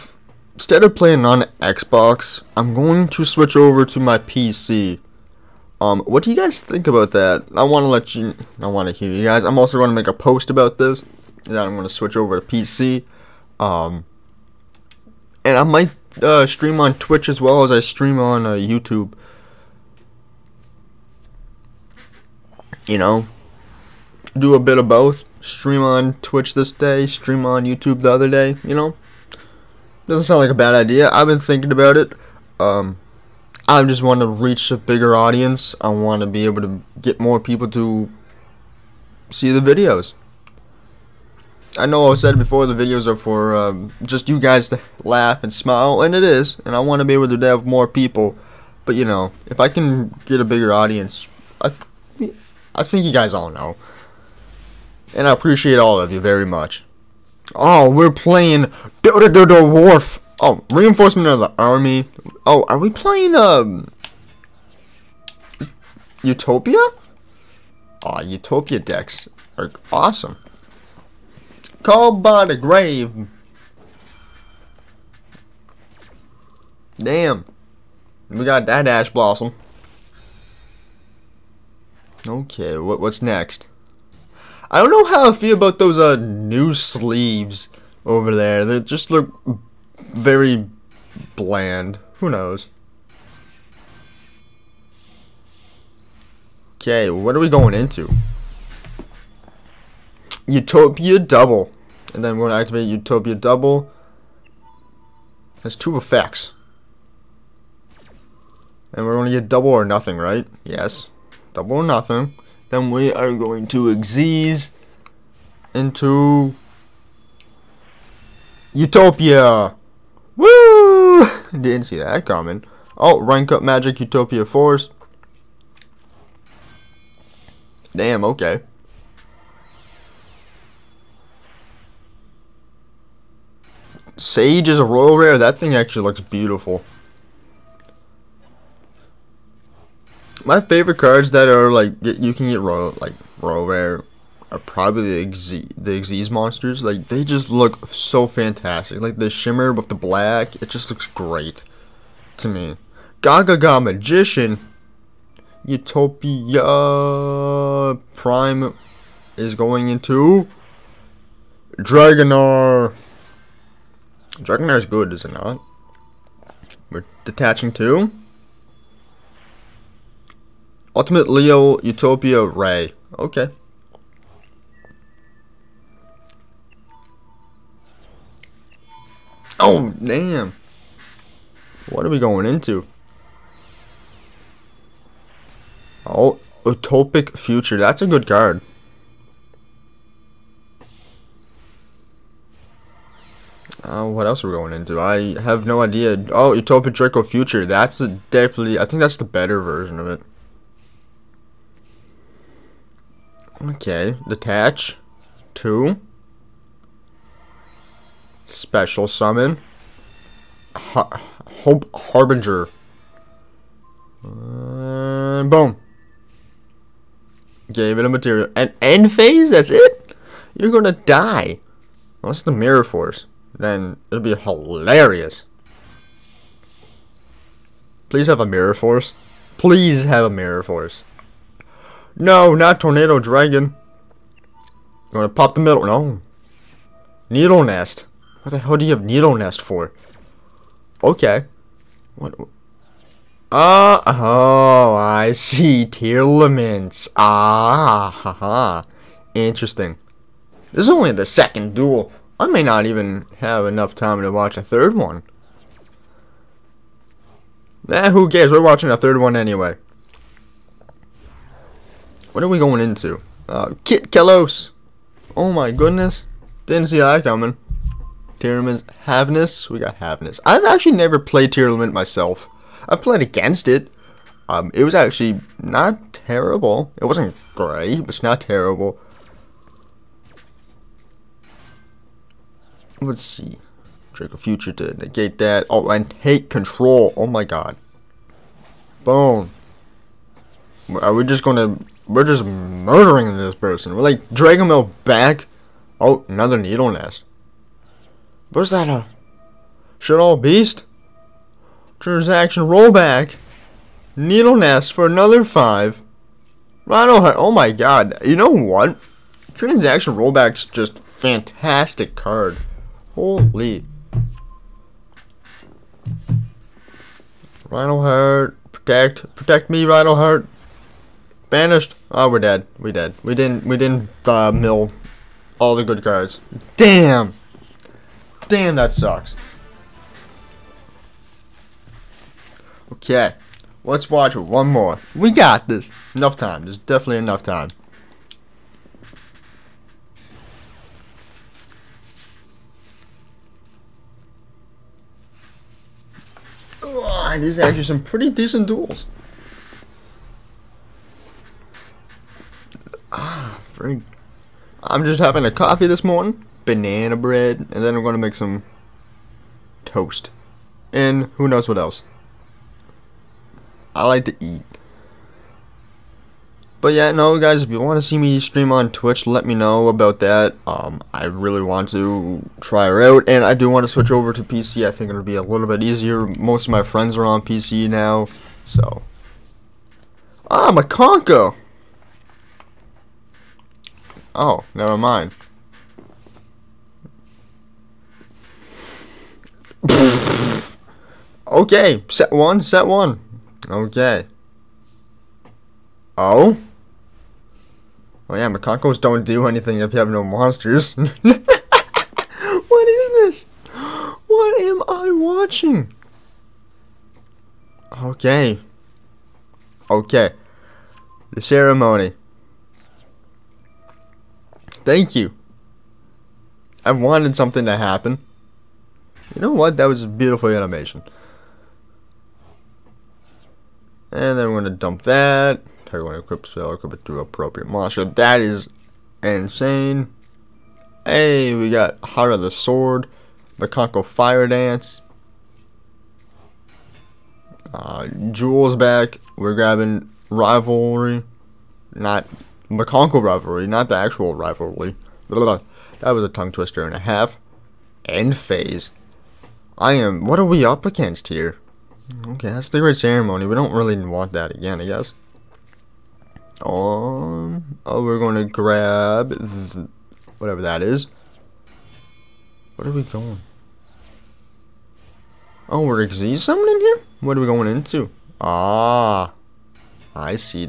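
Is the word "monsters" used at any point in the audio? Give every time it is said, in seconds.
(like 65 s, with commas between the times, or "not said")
146 s, 400 s, 427 s.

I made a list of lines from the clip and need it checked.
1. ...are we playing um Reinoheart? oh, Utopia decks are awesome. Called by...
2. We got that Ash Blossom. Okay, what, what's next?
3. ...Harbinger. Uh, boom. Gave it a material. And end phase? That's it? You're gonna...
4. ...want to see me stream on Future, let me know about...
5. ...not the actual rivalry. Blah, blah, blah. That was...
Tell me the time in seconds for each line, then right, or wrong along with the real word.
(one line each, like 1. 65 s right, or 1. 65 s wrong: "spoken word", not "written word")
1. 62 s wrong: "Utopia", not "Reinoheart"
2. 78 s right
3. 211 s right
4. 367 s wrong: "Twitch", not "Future"
5. 443 s right.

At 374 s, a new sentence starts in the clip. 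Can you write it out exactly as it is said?
I think it'll be a little bit easier.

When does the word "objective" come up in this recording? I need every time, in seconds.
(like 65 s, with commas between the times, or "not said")
not said.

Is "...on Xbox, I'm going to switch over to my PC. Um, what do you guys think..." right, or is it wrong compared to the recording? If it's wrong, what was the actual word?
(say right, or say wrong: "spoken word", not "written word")
right.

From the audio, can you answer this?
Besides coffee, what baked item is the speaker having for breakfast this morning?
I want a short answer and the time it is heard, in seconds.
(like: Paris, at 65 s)
Banana bread, at 356 s.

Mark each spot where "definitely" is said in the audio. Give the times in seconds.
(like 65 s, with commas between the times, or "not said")
198 s, 336 s.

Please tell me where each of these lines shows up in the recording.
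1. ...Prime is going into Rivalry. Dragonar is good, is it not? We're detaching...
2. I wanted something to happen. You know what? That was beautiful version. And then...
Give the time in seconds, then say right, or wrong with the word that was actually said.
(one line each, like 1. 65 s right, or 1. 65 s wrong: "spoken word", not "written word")
1. 158 s wrong: "Dragonar", not "Rivalry"
2. 416 s wrong: "animation", not "version".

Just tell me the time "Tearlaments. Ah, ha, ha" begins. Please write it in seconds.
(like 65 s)
245 s.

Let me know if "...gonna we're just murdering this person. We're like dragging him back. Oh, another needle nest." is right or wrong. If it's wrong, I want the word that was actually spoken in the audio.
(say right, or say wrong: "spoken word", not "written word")
right.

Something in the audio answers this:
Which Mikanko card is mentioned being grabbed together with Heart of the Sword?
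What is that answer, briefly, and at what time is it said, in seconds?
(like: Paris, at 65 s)
Mikanko Fire Dance, at 433 s.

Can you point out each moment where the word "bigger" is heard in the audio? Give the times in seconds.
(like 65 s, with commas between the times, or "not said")
34 s, 50 s.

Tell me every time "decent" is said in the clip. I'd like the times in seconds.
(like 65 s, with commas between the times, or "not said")
348 s.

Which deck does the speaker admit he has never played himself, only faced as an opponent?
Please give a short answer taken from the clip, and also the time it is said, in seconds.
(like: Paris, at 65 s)
Tearlament, at 270 s.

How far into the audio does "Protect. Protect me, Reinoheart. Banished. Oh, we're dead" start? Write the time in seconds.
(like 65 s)
318 s.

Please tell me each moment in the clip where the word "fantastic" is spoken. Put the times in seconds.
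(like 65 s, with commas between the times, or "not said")
148 s, 311 s.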